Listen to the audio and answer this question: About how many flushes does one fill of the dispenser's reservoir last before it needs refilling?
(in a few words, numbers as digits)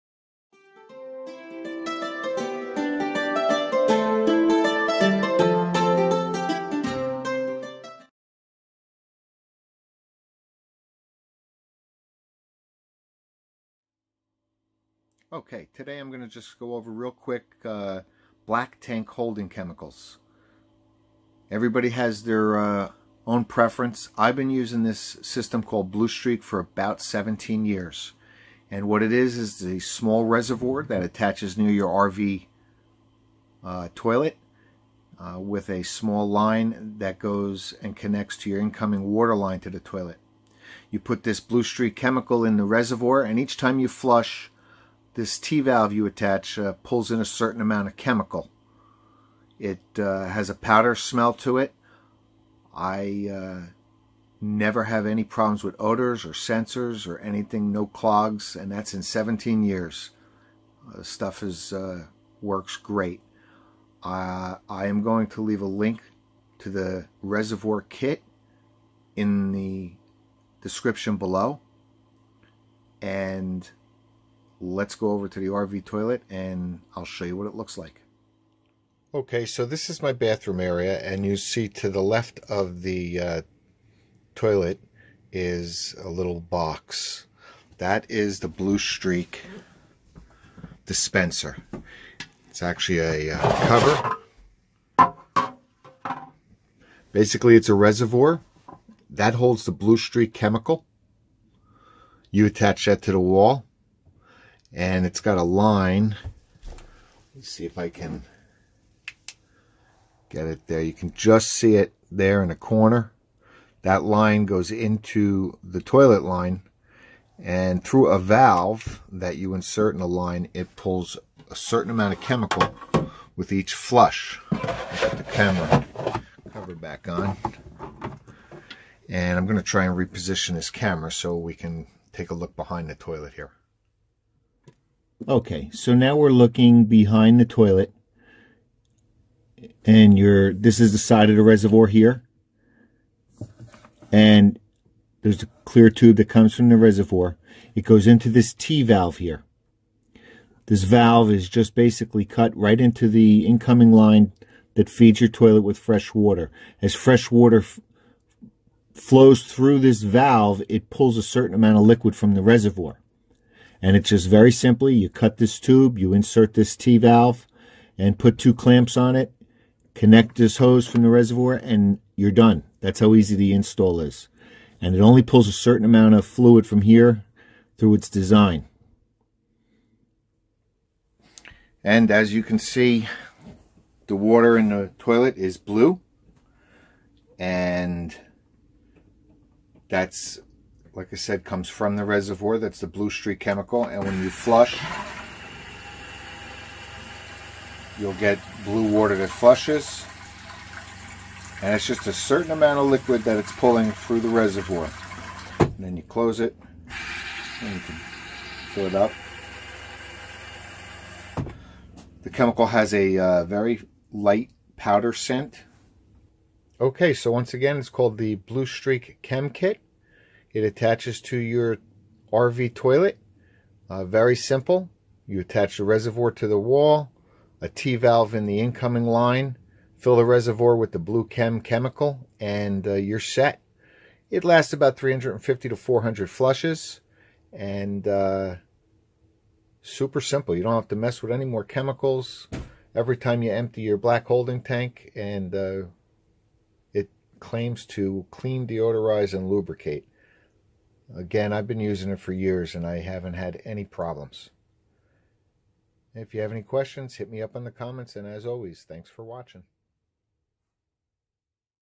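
350 to 400.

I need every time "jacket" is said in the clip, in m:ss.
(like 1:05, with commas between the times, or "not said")
not said.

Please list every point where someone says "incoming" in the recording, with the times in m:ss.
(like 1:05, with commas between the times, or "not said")
0:38, 2:33, 3:48.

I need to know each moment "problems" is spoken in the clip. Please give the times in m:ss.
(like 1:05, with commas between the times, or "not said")
0:55, 4:13.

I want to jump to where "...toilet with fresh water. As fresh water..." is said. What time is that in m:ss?
2:35.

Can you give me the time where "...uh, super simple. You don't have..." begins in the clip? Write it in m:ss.
3:58.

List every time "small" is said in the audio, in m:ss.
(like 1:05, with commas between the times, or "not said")
0:29, 0:35.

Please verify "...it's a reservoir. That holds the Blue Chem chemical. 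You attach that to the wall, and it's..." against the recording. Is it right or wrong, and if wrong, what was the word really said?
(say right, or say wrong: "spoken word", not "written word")
wrong: "Streak", not "Chem".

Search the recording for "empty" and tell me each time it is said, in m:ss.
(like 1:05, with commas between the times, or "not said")
4:03.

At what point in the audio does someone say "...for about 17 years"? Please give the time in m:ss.
0:26.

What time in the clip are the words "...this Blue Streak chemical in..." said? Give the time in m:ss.
0:41.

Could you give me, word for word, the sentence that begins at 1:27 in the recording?
That is the Blue Streak dispenser.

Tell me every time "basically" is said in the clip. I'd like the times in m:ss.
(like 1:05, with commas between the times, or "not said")
1:37, 2:31.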